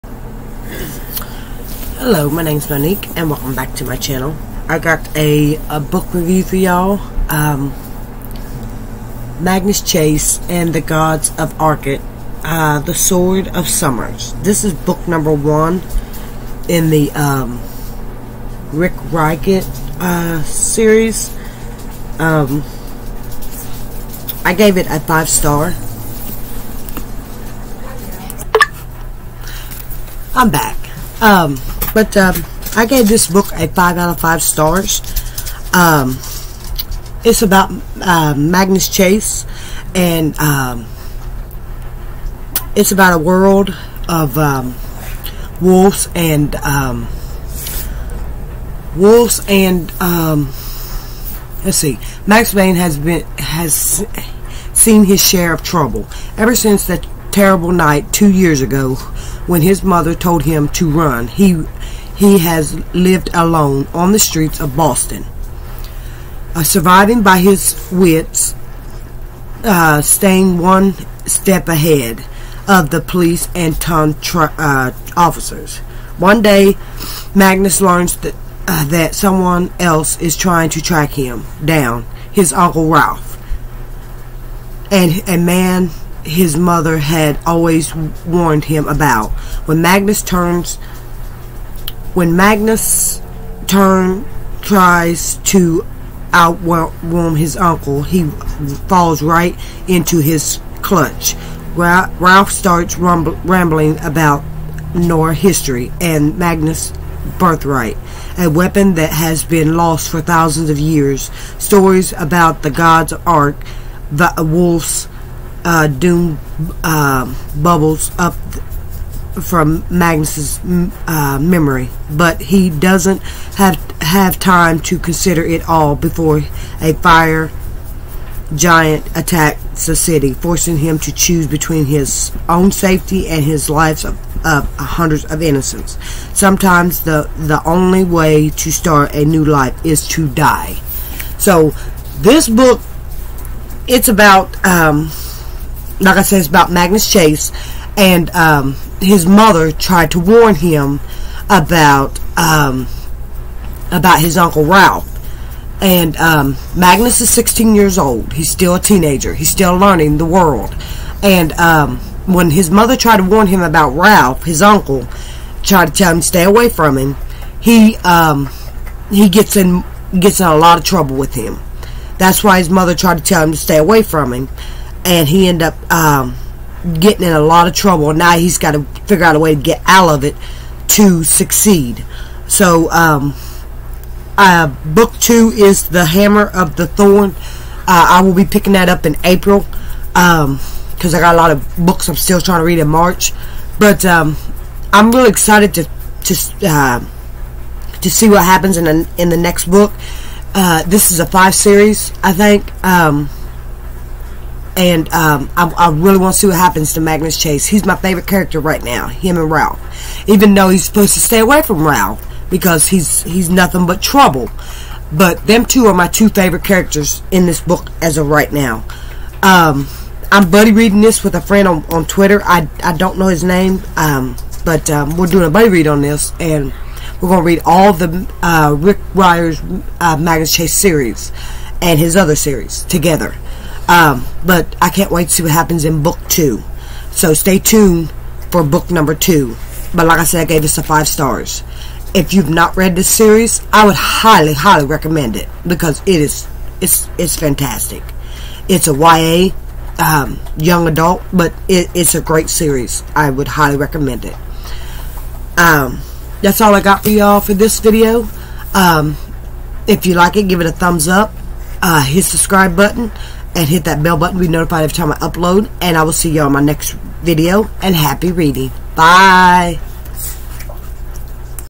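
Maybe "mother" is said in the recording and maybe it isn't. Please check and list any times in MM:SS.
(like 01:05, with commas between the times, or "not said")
00:59, 01:26, 02:29, 02:42, 02:52.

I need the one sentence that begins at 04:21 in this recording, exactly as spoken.
Uh, hit subscribe button and hit that bell button to be notified every time I upload.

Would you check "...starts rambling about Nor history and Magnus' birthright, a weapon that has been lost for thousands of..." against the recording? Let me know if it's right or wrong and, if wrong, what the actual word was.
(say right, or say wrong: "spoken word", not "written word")
right.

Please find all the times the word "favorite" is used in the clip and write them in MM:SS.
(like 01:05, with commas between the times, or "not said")
03:27, 03:36.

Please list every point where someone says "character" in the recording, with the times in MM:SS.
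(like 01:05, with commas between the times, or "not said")
03:28, 03:36.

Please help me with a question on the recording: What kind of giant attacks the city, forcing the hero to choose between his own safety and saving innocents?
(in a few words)
Fire giant.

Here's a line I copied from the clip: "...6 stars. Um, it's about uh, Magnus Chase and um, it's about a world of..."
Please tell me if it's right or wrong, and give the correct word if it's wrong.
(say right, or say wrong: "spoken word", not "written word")
wrong: "5", not "6".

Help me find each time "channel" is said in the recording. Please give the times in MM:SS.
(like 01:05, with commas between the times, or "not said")
00:03.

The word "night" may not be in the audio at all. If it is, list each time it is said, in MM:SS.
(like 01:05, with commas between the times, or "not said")
00:57.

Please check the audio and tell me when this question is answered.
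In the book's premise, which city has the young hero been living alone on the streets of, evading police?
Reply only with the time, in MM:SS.
01:04.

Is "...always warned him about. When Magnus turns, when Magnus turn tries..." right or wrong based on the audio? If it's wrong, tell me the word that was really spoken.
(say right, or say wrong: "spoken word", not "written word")
right.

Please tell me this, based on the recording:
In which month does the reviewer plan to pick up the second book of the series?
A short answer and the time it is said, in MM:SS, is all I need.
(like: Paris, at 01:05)
April, at 03:09.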